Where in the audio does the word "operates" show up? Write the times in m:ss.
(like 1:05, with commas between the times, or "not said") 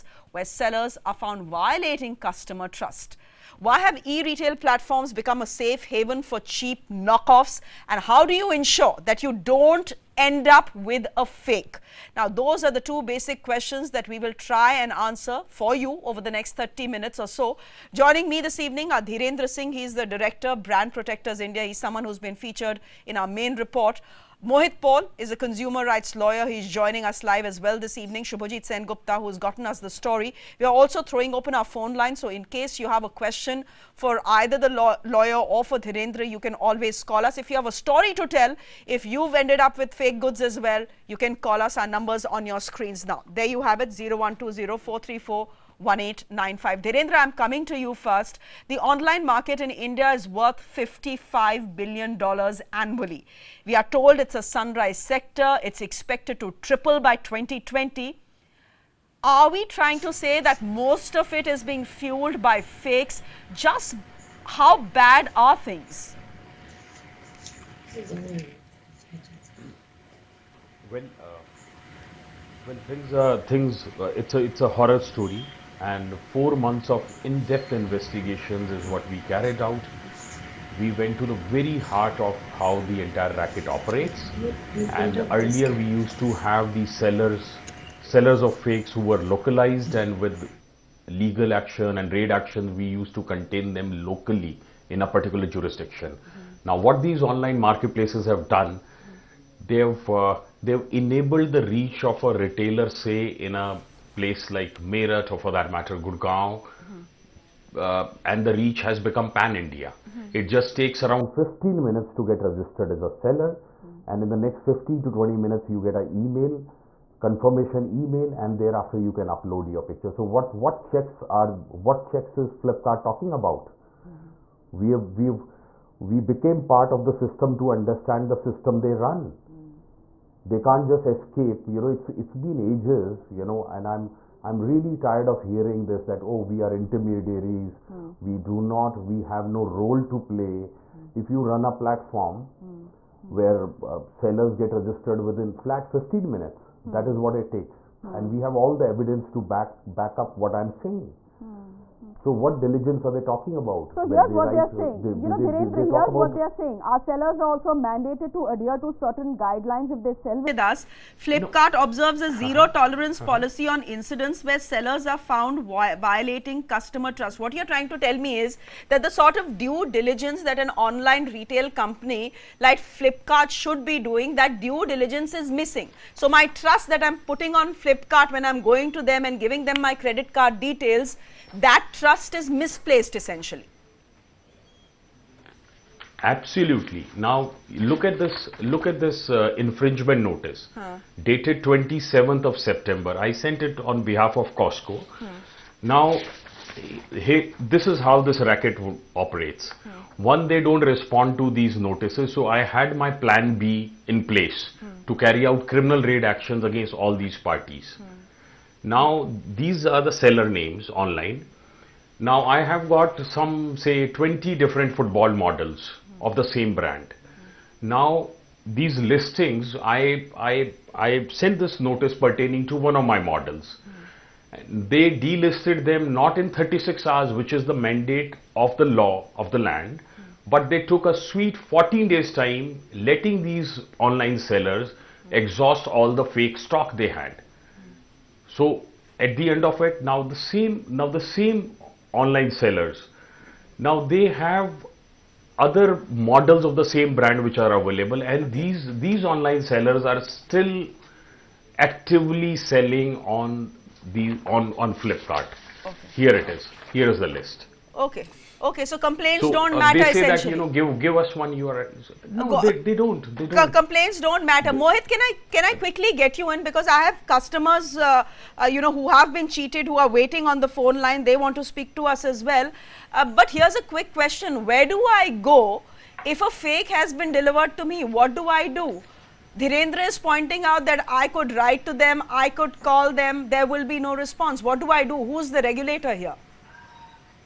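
1:23, 3:19.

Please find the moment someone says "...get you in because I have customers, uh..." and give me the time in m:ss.
4:26.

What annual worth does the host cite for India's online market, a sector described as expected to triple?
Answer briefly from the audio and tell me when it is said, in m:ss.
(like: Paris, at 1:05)
$55 billion, at 0:50.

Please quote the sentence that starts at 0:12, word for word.
Now, those are the two basic questions that we will try and answer for you over the next 30 minutes or so.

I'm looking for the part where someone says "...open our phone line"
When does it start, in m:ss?
0:31.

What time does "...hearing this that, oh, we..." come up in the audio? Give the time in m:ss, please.
2:15.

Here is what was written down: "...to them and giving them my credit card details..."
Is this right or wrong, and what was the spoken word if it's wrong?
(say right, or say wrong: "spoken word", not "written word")
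right.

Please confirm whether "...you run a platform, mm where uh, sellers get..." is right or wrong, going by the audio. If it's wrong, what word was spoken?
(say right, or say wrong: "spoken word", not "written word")
right.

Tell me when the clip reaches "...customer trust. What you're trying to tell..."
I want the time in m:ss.
2:46.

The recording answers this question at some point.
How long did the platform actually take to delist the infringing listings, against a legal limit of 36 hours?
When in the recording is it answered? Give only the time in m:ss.
3:51.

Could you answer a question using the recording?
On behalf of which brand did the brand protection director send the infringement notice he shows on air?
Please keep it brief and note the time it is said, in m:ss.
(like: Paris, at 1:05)
Cosco, at 3:14.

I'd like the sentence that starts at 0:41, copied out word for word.
Our numbers on your screens now.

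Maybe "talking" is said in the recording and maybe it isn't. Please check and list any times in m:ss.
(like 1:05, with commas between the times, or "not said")
2:03, 2:33.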